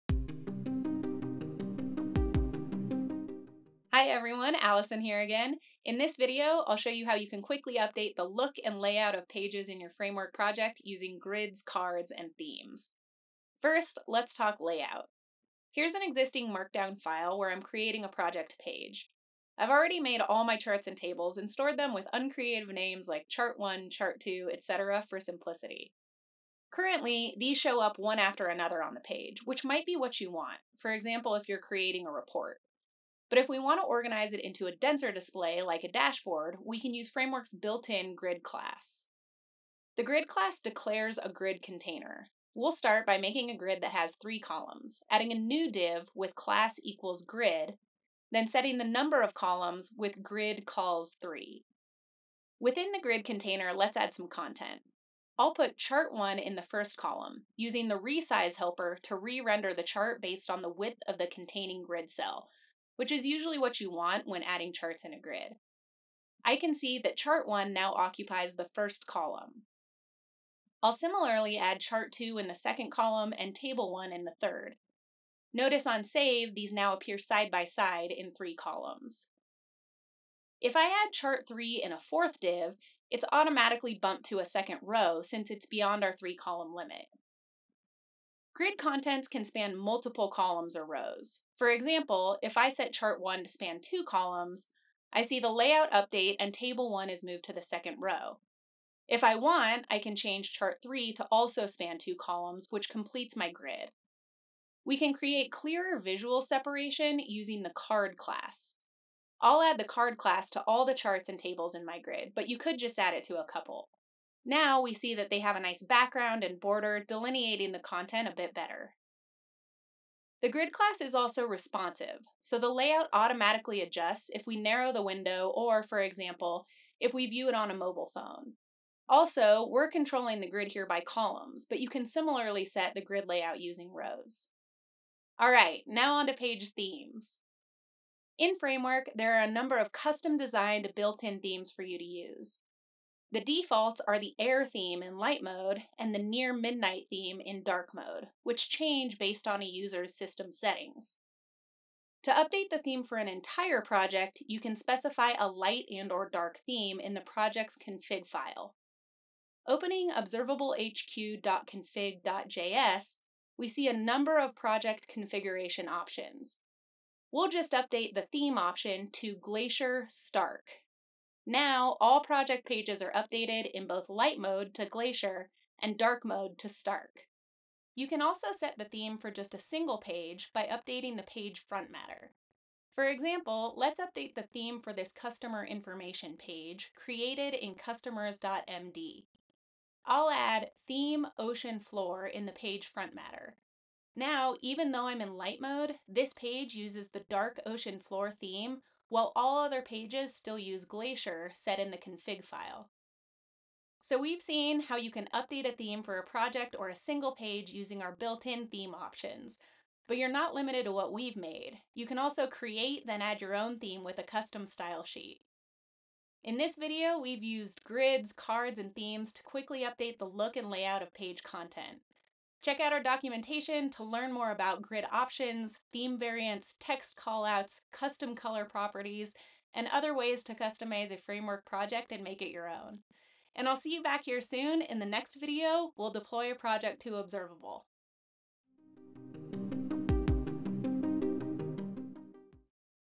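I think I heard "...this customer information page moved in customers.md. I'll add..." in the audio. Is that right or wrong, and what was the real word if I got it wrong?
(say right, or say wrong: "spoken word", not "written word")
wrong: "created", not "moved".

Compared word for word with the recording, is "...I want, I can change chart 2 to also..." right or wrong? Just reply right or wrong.
wrong.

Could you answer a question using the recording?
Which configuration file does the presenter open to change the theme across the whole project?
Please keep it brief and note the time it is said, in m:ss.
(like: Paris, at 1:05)
observablehq.config.js, at 2:40.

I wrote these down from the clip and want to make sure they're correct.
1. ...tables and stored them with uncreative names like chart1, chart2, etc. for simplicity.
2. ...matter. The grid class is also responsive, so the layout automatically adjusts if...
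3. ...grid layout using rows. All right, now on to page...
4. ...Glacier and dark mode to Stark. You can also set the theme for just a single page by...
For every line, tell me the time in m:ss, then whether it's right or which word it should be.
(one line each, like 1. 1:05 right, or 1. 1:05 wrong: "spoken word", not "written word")
1. 0:20 right
2. 1:58 wrong: "better", not "matter"
3. 2:13 right
4. 2:54 right.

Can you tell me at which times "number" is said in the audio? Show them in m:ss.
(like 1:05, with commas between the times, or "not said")
0:48, 2:19, 2:43.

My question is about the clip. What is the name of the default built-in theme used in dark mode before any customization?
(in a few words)
near midnight.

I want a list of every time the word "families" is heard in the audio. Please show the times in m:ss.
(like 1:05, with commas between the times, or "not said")
not said.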